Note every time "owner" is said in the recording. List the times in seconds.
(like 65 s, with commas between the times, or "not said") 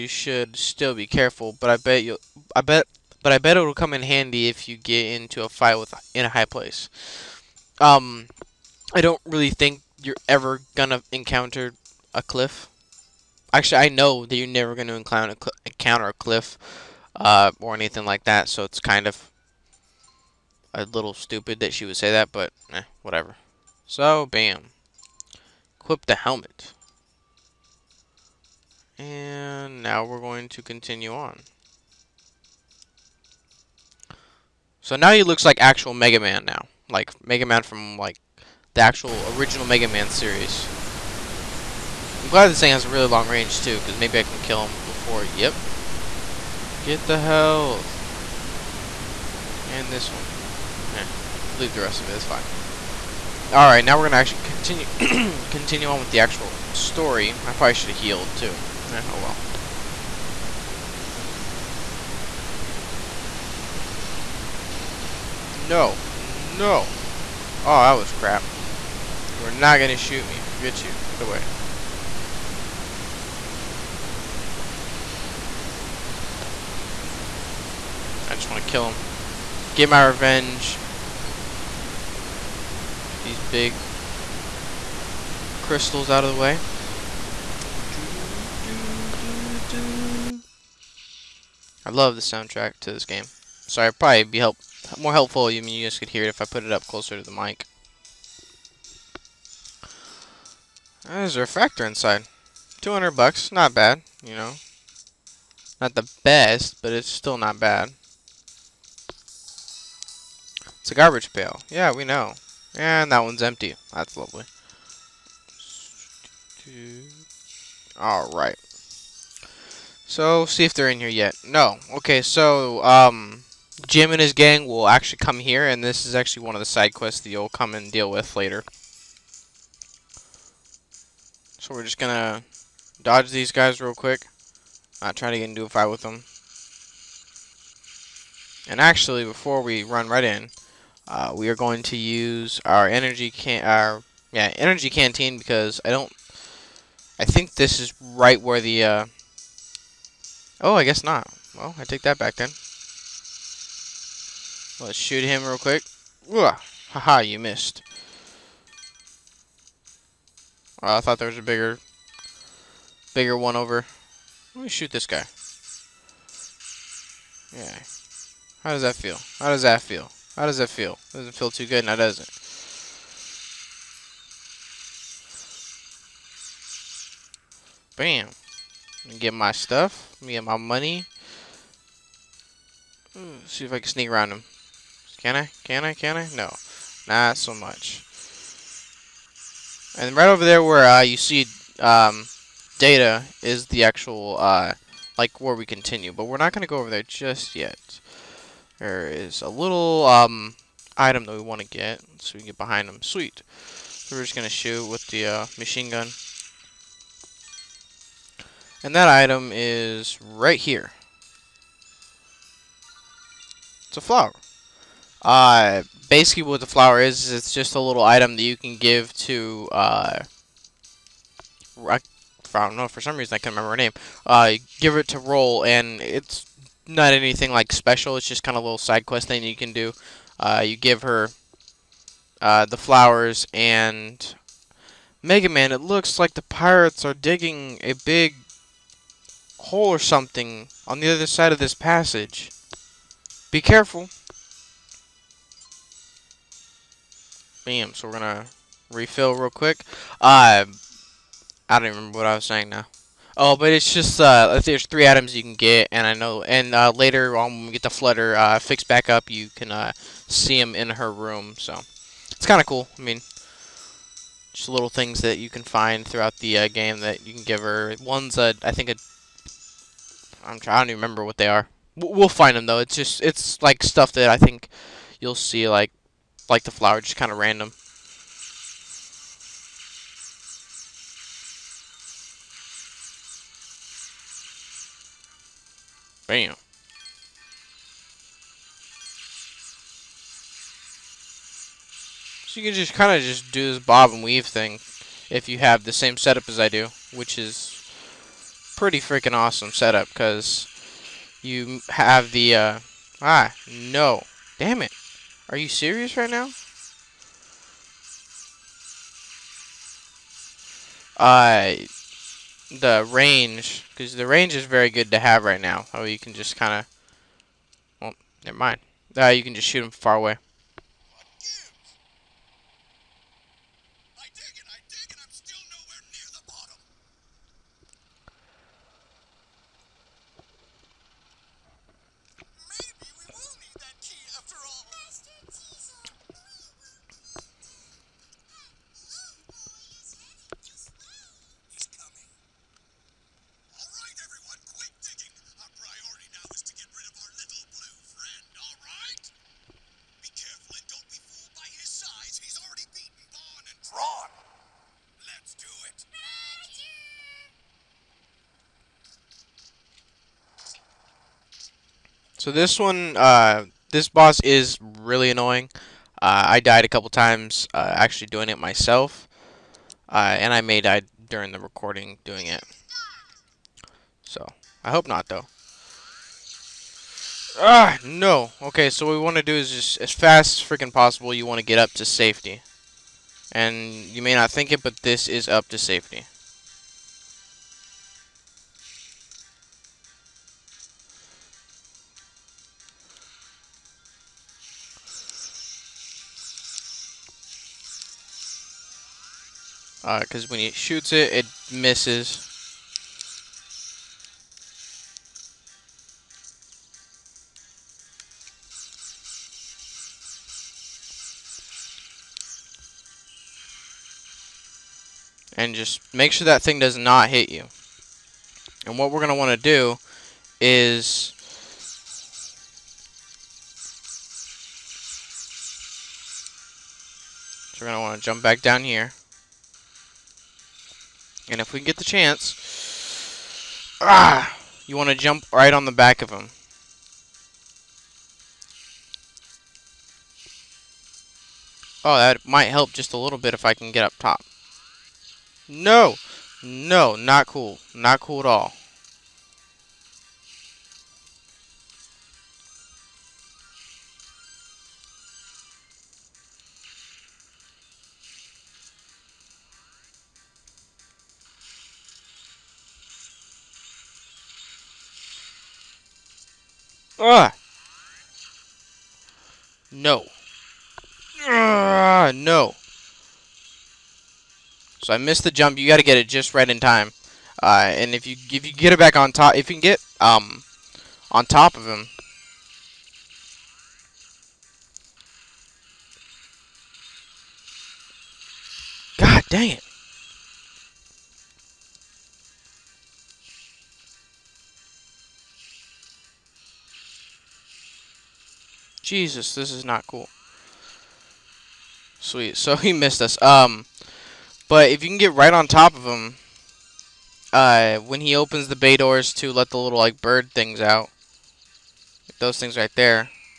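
not said.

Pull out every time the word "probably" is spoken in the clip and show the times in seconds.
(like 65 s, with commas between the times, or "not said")
57 s, 93 s.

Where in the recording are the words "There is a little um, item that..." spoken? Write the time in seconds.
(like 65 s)
198 s.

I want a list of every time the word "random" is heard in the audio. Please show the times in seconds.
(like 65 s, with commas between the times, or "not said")
277 s.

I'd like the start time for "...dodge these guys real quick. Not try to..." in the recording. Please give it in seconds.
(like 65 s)
133 s.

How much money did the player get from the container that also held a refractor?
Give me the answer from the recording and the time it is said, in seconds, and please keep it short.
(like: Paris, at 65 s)
200 bucks, at 102 s.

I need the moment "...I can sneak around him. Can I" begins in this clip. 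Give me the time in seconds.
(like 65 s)
183 s.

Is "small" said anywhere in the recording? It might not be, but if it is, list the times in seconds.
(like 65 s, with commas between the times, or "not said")
not said.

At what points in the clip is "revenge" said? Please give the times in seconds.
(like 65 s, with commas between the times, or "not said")
80 s.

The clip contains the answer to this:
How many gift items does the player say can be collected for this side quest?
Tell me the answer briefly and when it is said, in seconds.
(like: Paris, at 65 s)
3, at 254 s.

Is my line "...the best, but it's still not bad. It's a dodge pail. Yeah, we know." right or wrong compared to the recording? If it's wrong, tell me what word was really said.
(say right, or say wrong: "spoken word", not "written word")
wrong: "garbage", not "dodge".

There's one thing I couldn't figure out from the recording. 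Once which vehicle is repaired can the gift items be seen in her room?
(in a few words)
the Flutter.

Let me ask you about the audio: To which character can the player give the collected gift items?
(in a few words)
Roll.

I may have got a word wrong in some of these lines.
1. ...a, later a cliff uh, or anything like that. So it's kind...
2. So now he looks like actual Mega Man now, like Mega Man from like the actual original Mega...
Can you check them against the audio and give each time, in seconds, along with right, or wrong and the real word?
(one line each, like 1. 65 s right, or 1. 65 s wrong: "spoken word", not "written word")
1. 15 s wrong: "encounter", not "later"
2. 34 s right.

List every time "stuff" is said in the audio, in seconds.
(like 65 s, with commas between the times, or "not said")
179 s, 273 s.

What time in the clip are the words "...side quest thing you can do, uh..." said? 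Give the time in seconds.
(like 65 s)
228 s.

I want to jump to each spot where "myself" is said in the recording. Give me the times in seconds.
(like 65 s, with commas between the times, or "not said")
368 s.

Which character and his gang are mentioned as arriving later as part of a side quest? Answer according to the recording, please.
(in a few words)
Jim.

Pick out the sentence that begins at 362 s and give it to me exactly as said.
So this one, uh, this boss is really annoying.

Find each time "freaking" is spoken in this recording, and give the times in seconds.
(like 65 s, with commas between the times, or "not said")
298 s, 380 s.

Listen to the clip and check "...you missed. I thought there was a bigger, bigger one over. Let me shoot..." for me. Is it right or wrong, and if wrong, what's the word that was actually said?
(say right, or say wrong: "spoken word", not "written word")
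right.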